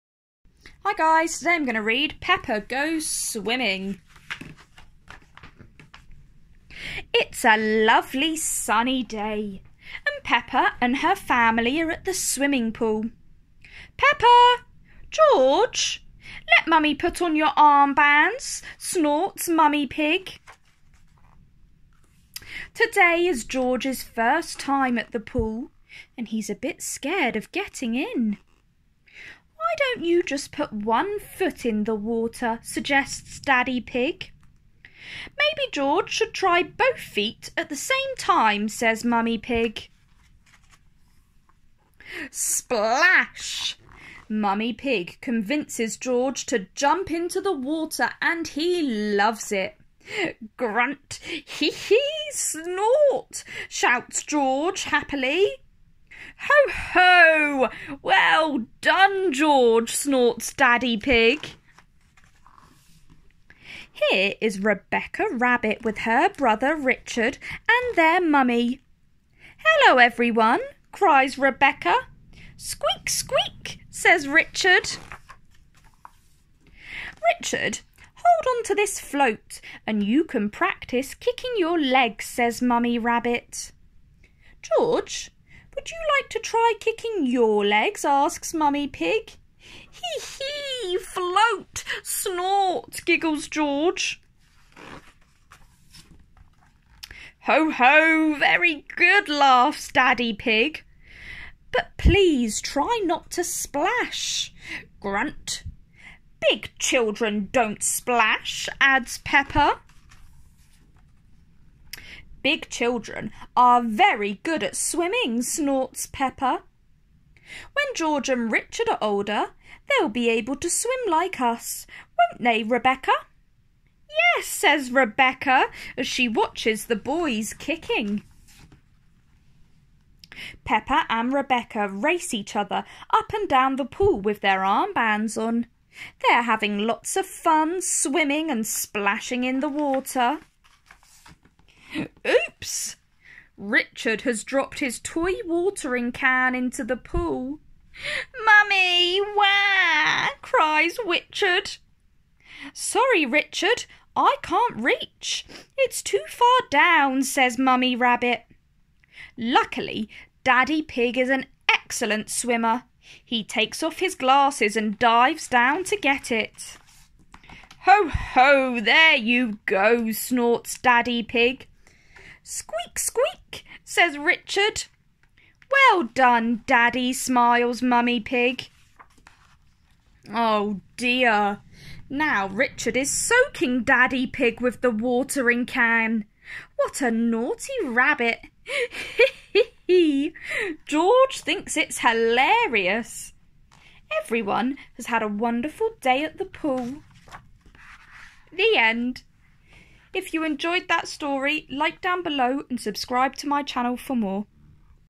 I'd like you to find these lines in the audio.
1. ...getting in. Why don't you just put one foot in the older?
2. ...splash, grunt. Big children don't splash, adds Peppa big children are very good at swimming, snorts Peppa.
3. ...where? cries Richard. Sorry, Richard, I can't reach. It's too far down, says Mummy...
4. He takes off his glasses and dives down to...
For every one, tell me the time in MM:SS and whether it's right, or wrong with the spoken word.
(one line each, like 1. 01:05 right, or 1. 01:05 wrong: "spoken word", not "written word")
1. 00:27 wrong: "water", not "older"
2. 01:43 right
3. 02:29 right
4. 02:43 right.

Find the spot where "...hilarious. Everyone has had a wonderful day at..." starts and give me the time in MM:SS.
03:11.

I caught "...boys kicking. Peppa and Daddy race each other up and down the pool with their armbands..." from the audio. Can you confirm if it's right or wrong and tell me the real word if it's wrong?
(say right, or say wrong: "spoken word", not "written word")
wrong: "Rebecca", not "Daddy".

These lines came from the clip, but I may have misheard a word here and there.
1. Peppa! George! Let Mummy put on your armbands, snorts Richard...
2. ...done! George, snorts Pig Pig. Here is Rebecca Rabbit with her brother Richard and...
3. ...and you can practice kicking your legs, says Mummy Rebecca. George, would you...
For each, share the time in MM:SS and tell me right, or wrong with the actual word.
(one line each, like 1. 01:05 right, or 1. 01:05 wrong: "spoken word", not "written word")
1. 00:13 wrong: "Mummy", not "Richard"
2. 00:58 wrong: "Daddy", not "Pig"
3. 01:19 wrong: "Rabbit", not "Rebecca".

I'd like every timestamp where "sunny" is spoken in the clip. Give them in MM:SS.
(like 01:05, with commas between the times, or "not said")
00:08.